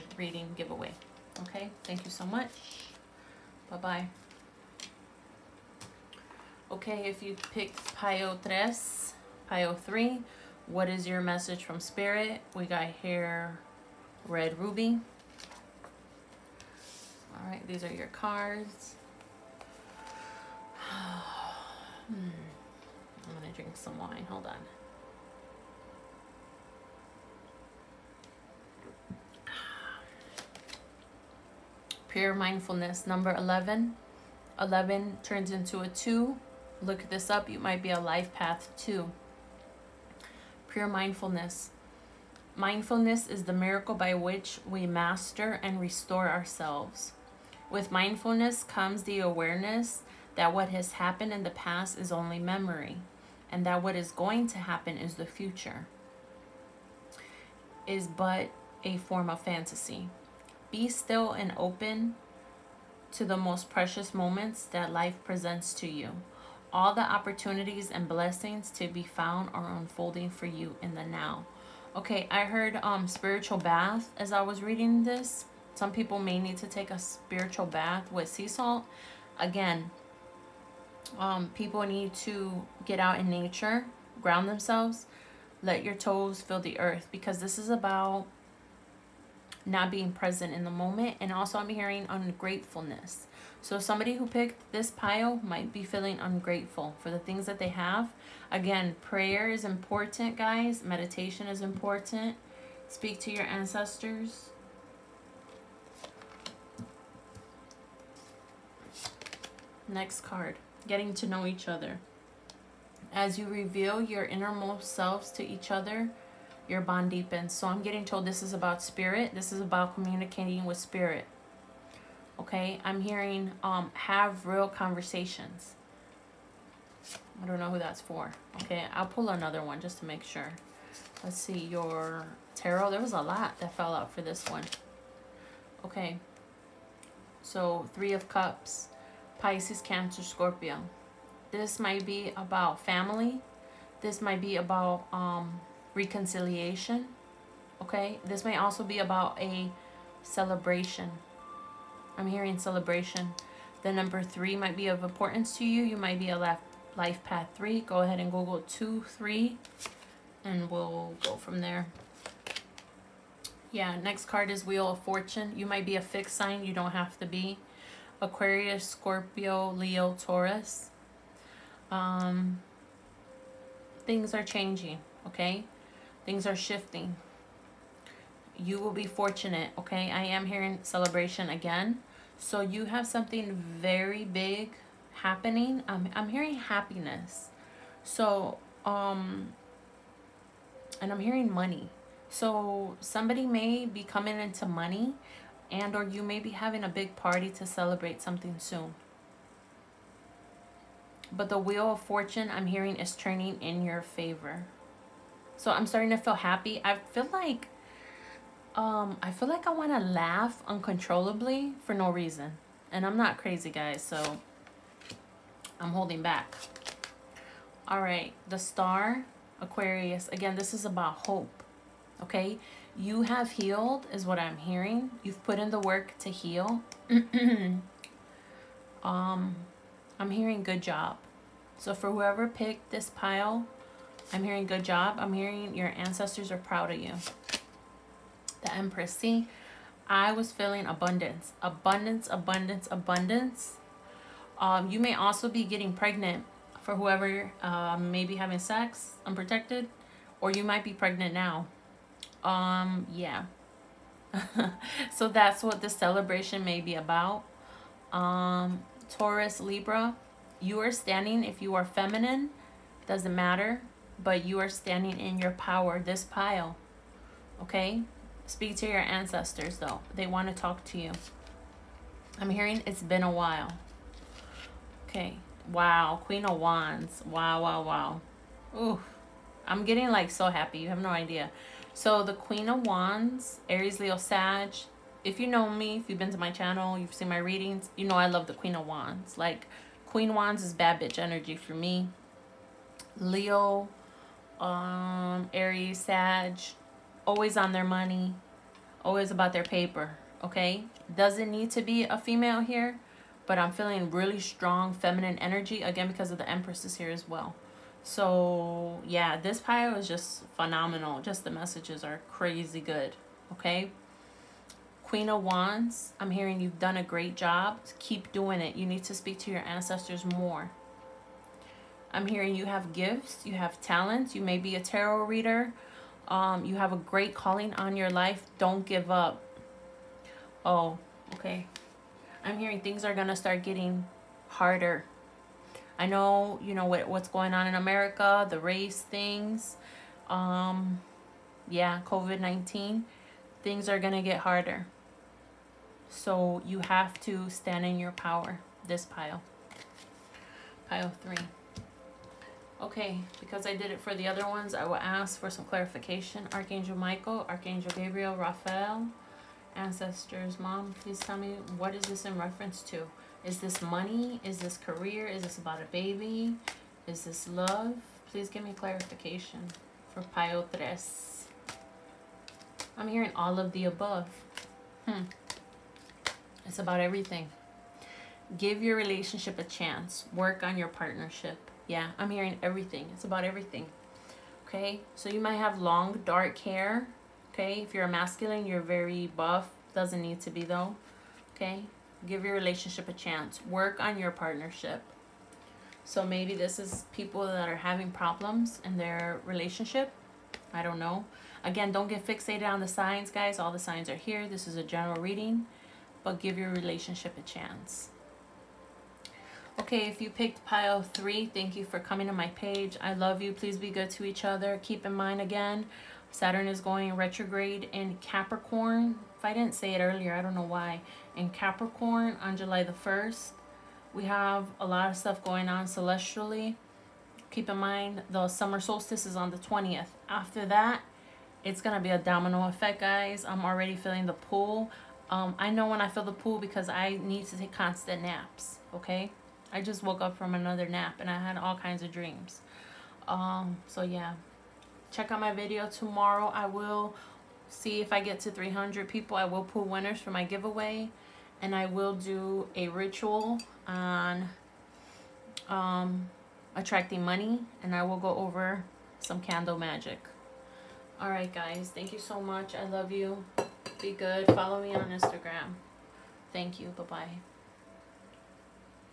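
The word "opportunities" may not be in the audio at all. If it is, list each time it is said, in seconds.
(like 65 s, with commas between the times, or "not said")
67 s.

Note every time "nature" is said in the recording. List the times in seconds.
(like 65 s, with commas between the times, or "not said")
83 s.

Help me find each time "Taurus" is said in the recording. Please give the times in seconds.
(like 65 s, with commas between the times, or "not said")
170 s, 259 s.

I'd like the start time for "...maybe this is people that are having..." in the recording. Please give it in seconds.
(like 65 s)
396 s.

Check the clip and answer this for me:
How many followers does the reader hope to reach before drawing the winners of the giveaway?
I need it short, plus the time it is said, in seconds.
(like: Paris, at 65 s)
300, at 448 s.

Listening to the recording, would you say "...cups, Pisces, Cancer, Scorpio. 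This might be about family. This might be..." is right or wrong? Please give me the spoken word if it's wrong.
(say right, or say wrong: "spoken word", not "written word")
right.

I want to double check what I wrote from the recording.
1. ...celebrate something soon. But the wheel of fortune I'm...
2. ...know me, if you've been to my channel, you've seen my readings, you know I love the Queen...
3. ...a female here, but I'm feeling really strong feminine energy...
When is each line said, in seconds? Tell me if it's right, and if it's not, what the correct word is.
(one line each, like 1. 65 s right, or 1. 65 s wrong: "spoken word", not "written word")
1. 197 s right
2. 285 s right
3. 302 s right.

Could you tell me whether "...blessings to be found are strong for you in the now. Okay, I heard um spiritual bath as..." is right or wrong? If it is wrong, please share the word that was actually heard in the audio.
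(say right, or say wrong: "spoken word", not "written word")
wrong: "unfolding", not "strong".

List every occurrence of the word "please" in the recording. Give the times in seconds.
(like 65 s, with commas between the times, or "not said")
360 s, 368 s, 413 s.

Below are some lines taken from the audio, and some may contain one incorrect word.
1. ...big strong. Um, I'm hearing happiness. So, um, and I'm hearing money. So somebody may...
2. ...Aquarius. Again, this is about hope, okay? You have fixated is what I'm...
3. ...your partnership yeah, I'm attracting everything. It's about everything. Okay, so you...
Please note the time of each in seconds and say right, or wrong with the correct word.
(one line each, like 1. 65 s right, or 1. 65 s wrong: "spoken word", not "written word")
1. 184 s wrong: "happening", not "strong"
2. 219 s wrong: "healed", not "fixated"
3. 380 s wrong: "hearing", not "attracting".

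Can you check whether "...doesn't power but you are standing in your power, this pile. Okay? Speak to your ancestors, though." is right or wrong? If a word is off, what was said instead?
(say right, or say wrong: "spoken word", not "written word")
wrong: "matter", not "power".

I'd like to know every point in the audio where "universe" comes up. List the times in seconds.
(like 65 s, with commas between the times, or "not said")
not said.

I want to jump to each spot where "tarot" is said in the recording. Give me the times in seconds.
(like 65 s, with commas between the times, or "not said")
132 s, 324 s.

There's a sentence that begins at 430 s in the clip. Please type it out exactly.
After that, it's going to be a domino effect, guys.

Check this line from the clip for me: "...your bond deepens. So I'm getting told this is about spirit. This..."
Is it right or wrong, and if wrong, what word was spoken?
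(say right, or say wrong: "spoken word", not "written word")
right.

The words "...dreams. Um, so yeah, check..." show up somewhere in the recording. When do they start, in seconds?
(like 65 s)
442 s.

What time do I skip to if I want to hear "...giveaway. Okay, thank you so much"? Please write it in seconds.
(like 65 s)
0 s.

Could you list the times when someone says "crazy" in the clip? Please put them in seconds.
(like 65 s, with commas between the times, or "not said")
213 s, 312 s.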